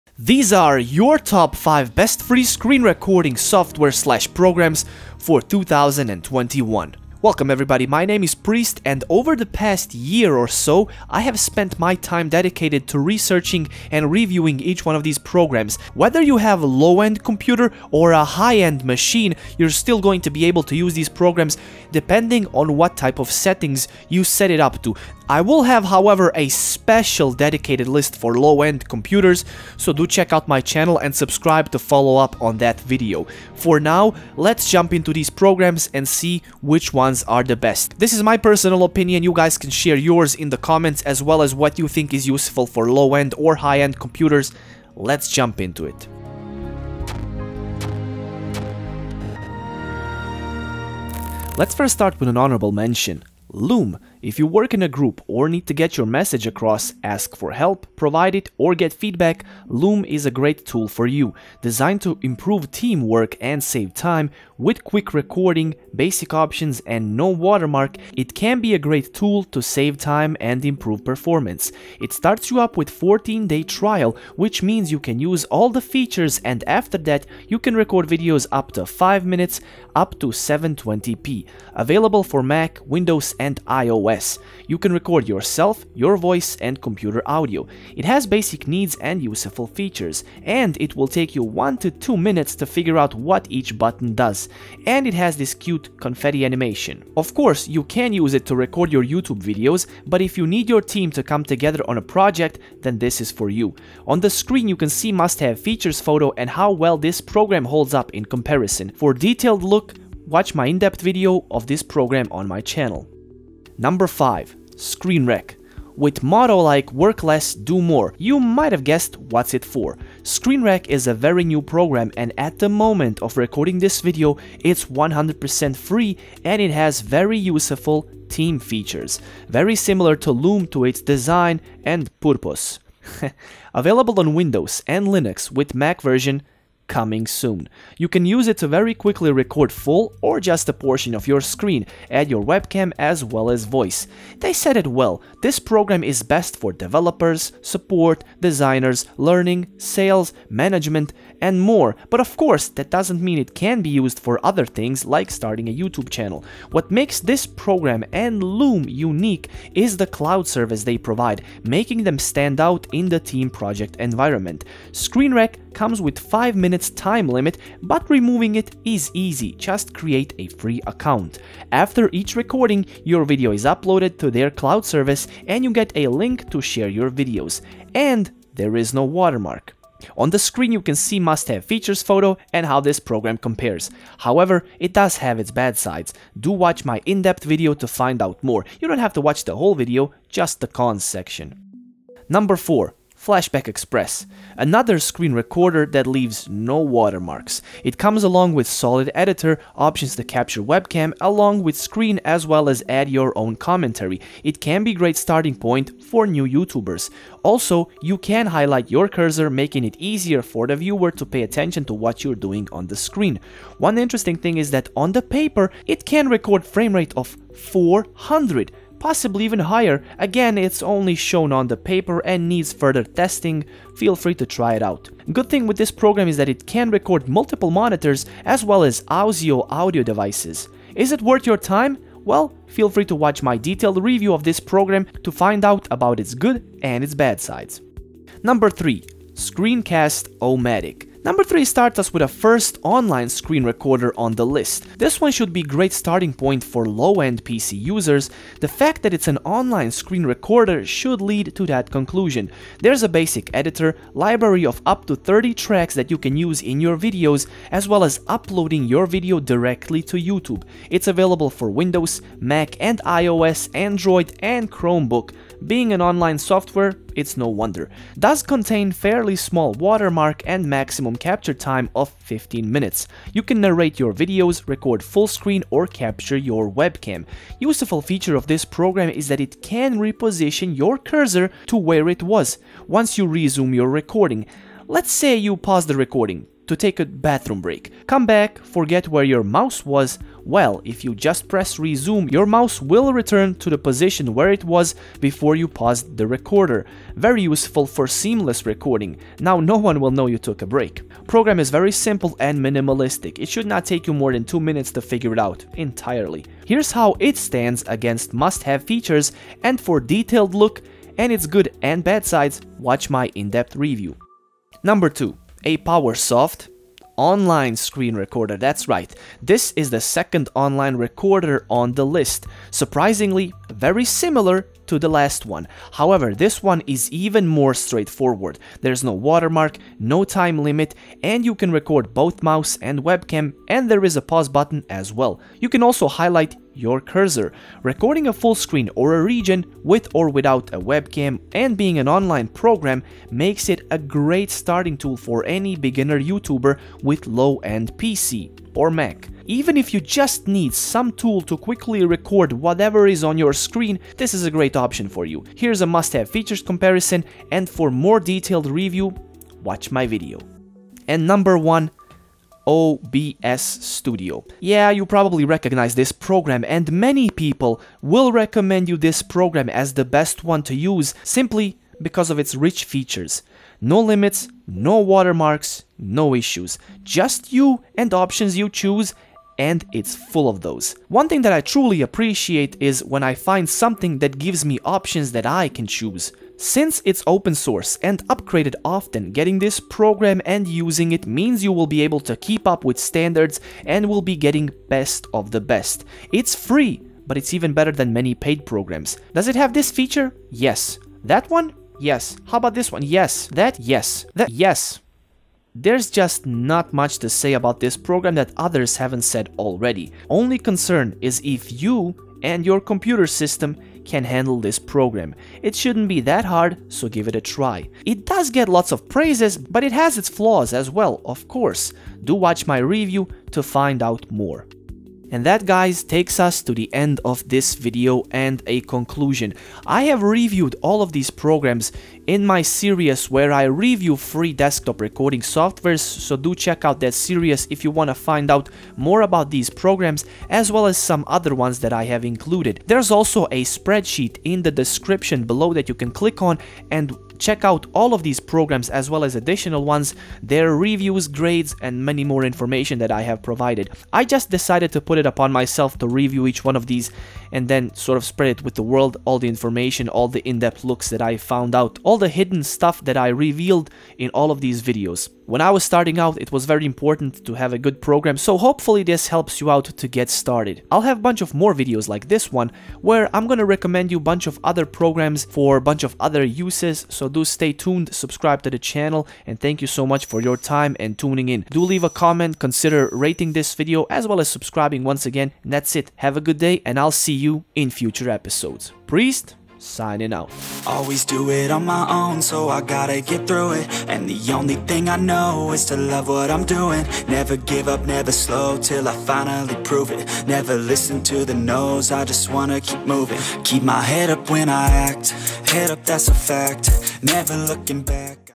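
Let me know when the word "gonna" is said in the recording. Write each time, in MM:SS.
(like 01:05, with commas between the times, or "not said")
07:53.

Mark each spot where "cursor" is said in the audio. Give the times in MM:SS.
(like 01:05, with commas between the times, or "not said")
03:29, 04:40, 05:36.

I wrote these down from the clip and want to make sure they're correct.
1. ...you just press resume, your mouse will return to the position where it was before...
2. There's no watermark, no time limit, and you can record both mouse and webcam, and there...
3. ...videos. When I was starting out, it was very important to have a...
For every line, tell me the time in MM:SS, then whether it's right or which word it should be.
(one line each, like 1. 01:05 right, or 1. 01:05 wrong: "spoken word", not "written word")
1. 04:51 right
2. 05:28 right
3. 07:44 right.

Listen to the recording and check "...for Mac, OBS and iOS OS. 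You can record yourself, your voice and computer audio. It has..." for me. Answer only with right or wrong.
wrong.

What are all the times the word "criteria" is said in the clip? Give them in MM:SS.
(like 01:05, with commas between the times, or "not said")
not said.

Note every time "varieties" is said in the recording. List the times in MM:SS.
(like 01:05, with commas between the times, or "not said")
not said.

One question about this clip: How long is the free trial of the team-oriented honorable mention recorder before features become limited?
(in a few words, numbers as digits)
14 days.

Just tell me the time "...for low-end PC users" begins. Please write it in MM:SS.
04:06.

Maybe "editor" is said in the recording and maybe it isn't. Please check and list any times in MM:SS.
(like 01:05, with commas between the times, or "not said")
03:19, 04:13.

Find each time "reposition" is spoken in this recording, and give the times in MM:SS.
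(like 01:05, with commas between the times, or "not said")
04:39.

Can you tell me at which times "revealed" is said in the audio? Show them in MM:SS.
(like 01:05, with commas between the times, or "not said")
07:43.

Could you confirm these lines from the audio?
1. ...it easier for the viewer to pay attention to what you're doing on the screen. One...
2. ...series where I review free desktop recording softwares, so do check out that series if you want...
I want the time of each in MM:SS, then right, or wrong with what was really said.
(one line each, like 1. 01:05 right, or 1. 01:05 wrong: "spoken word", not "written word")
1. 03:29 right
2. 07:12 right.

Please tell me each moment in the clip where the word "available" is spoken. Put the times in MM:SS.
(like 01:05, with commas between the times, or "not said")
01:21, 02:13, 04:21.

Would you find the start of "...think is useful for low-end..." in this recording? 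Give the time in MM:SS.
00:41.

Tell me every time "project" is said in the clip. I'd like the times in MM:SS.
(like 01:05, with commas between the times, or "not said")
01:42, 02:43.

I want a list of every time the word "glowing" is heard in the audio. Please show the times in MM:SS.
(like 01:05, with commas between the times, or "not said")
not said.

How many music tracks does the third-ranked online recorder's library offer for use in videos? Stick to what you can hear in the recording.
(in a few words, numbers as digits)
30.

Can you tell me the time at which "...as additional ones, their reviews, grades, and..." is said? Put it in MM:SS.
07:29.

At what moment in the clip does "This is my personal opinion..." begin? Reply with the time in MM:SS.
00:37.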